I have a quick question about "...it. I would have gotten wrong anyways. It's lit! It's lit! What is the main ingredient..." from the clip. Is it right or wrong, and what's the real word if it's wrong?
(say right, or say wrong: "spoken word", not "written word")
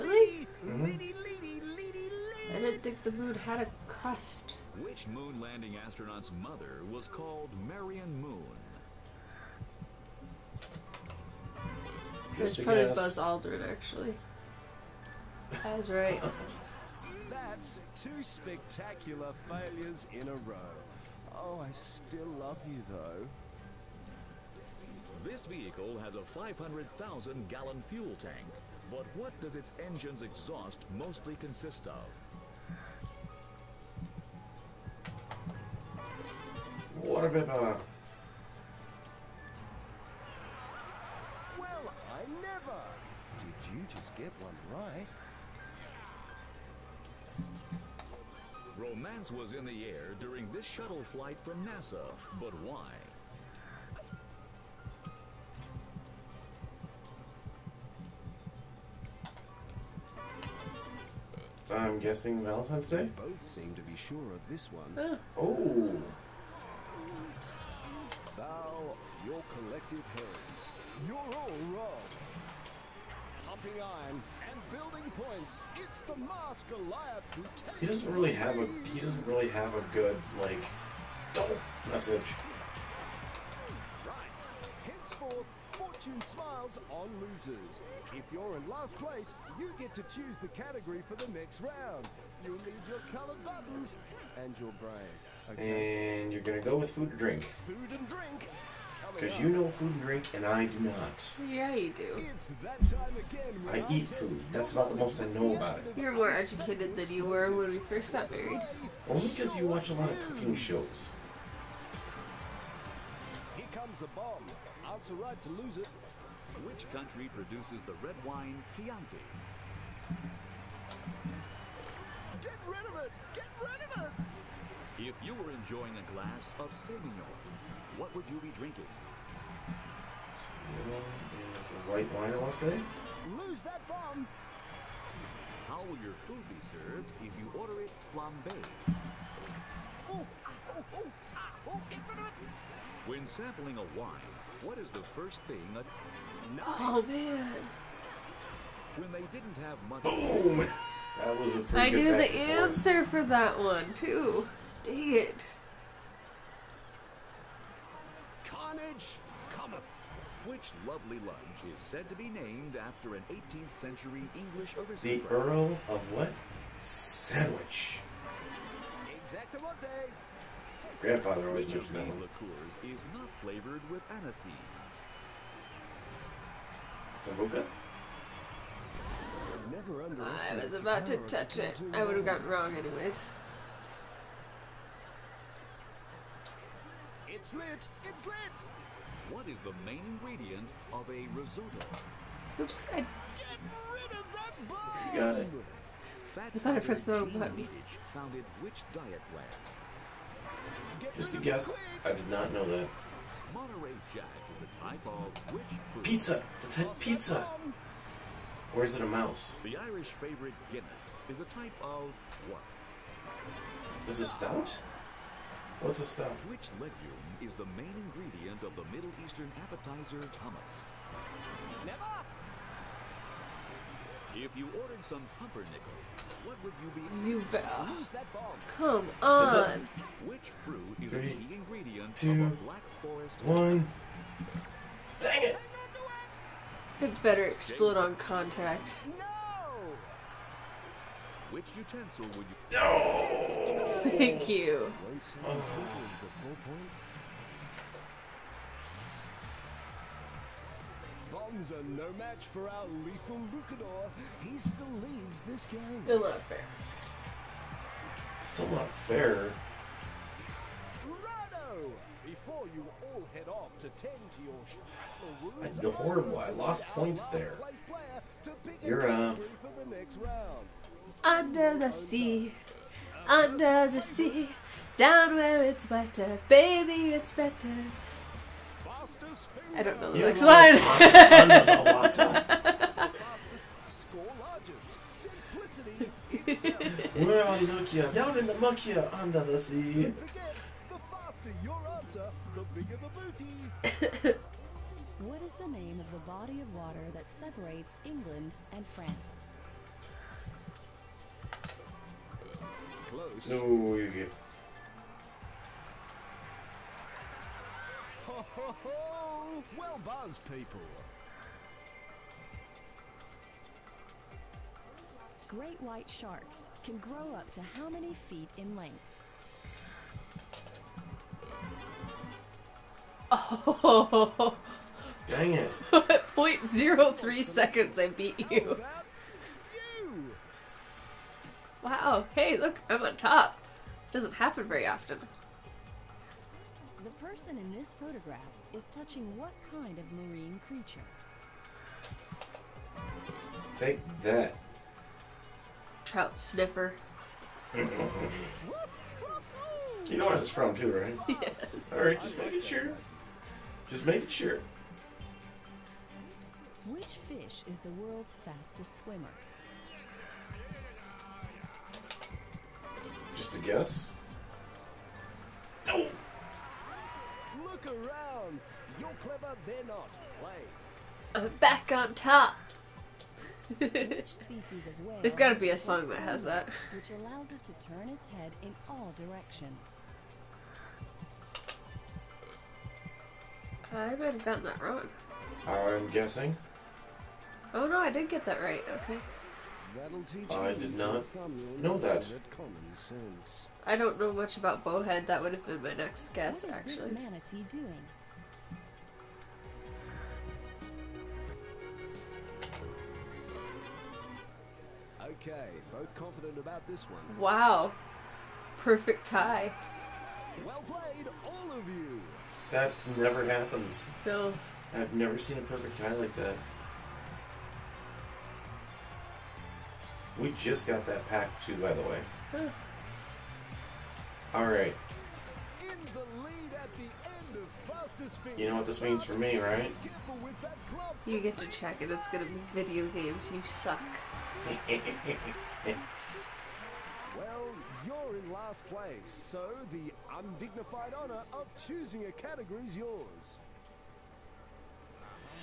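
right.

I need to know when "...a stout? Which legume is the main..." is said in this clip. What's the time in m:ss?
3:35.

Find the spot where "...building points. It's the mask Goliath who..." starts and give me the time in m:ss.
1:14.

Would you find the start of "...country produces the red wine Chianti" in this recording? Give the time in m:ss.
1:56.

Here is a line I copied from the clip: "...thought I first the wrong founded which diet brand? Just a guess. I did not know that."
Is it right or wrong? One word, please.
right.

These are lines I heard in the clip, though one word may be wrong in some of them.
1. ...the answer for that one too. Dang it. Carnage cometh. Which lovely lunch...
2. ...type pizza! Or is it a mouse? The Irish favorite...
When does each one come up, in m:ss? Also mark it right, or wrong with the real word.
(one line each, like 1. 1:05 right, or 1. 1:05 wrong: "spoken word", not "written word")
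1. 2:32 right
2. 3:26 right.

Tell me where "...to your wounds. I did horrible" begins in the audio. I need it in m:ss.
4:24.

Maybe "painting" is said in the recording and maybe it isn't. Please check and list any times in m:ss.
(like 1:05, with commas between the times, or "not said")
not said.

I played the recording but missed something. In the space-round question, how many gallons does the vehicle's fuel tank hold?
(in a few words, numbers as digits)
500,000.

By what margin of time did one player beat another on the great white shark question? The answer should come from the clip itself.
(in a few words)
0.03 seconds.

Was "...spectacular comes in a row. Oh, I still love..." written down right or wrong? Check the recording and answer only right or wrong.
wrong.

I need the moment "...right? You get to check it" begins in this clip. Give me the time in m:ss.
7:09.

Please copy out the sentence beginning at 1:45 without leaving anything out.
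You're more educated than you were when we first got married.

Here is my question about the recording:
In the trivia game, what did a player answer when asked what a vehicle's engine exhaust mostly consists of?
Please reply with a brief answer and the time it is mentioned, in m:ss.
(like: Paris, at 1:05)
Water vapor, at 0:37.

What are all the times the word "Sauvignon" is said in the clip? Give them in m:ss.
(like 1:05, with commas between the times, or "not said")
2:06.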